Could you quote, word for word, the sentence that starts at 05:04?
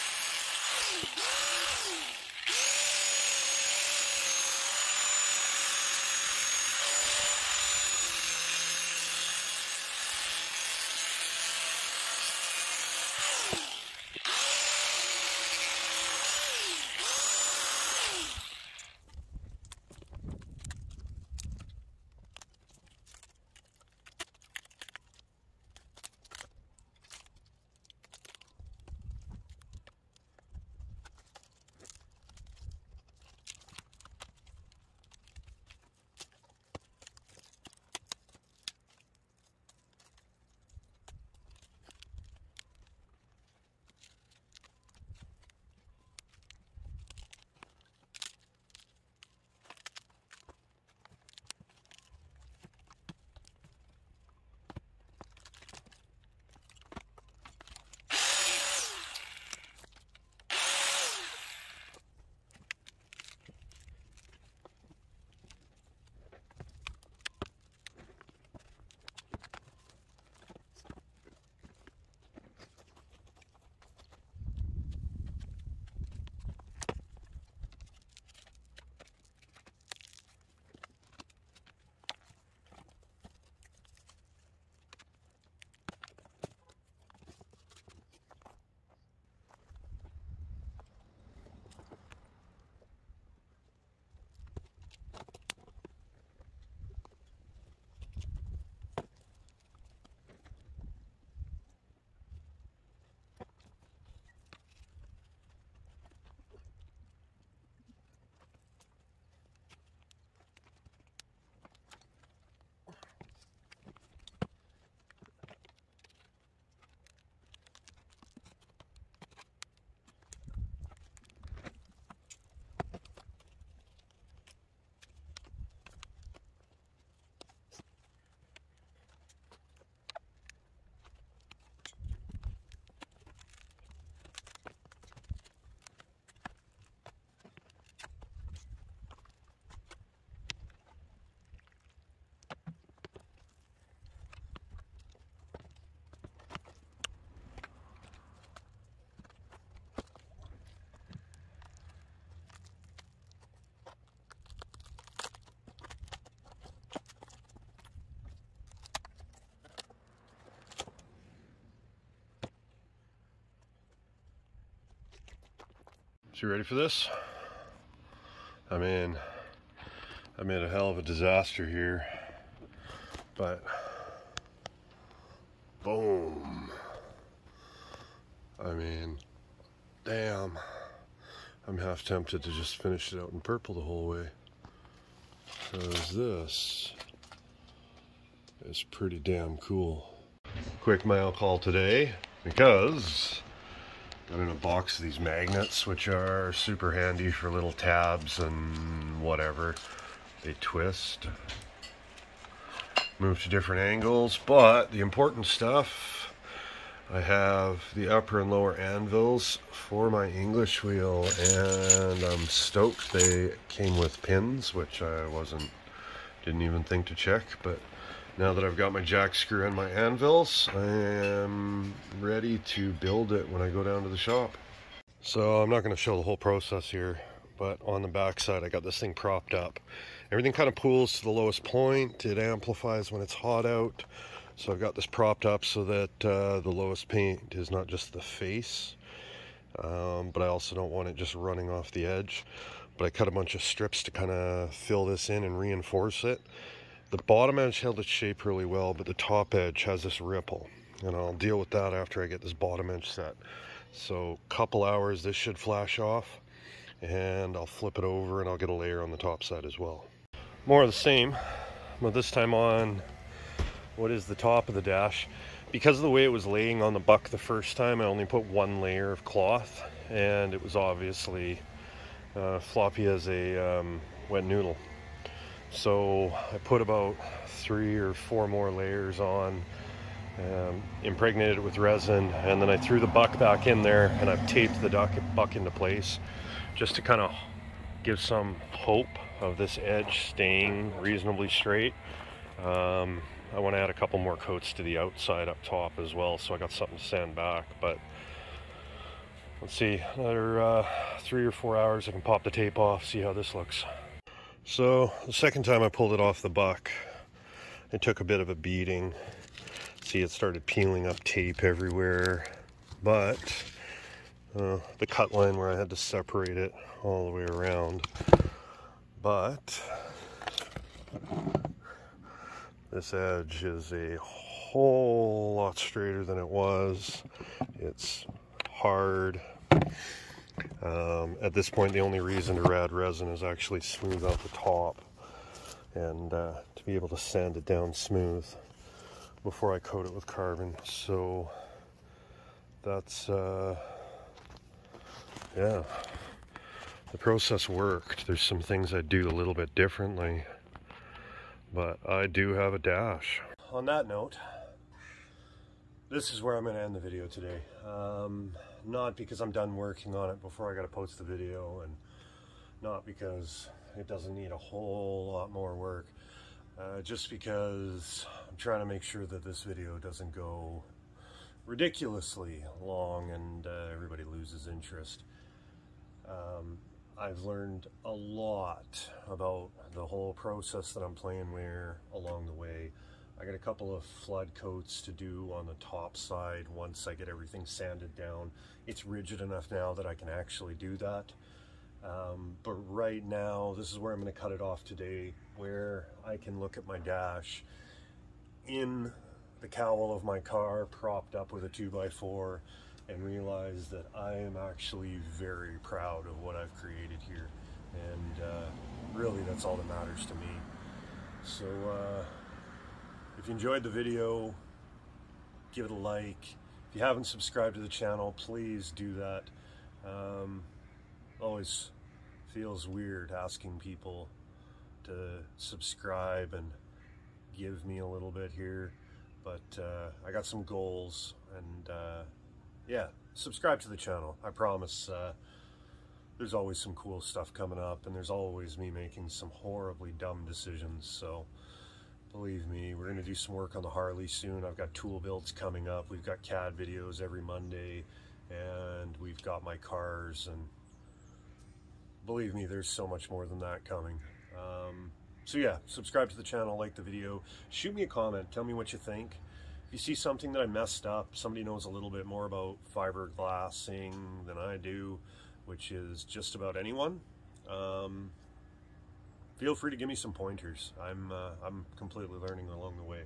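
So the second time I pulled it off the buck, it took a bit of a beating.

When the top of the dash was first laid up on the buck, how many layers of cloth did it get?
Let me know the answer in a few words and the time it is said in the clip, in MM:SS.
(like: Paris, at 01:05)
1, at 04:28.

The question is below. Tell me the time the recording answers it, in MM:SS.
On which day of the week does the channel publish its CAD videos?
07:27.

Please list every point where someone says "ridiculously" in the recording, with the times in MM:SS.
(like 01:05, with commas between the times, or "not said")
06:11.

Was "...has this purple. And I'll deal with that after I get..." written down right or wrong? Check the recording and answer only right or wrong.
wrong.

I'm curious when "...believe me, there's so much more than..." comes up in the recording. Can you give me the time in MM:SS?
07:32.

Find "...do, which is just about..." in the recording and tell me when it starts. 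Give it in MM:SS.
07:44.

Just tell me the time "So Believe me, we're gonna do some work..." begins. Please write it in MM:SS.
07:21.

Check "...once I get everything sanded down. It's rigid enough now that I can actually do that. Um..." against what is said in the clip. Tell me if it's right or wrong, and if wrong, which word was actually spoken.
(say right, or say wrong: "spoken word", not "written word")
right.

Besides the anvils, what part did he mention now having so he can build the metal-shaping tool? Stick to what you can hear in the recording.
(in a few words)
Jack screw.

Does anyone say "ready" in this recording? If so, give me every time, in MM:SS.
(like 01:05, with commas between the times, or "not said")
02:46, 03:42.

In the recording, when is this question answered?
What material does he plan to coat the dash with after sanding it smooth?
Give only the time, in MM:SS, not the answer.
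05:40.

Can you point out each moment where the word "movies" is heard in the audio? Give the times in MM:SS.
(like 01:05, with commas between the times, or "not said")
not said.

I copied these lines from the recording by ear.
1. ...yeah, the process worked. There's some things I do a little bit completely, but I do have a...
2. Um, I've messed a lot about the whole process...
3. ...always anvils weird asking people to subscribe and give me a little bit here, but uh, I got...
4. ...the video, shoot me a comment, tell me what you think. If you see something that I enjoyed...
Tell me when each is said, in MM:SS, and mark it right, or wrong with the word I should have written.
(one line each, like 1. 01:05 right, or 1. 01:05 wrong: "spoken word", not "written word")
1. 05:45 wrong: "differently", not "completely"
2. 06:16 wrong: "learned", not "messed"
3. 07:01 wrong: "feels", not "anvils"
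4. 07:36 wrong: "messed", not "enjoyed".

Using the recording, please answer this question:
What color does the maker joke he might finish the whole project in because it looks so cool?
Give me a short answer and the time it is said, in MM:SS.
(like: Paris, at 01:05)
Purple, at 03:03.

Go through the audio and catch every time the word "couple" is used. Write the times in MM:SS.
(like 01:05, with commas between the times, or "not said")
04:14, 04:53, 06:23.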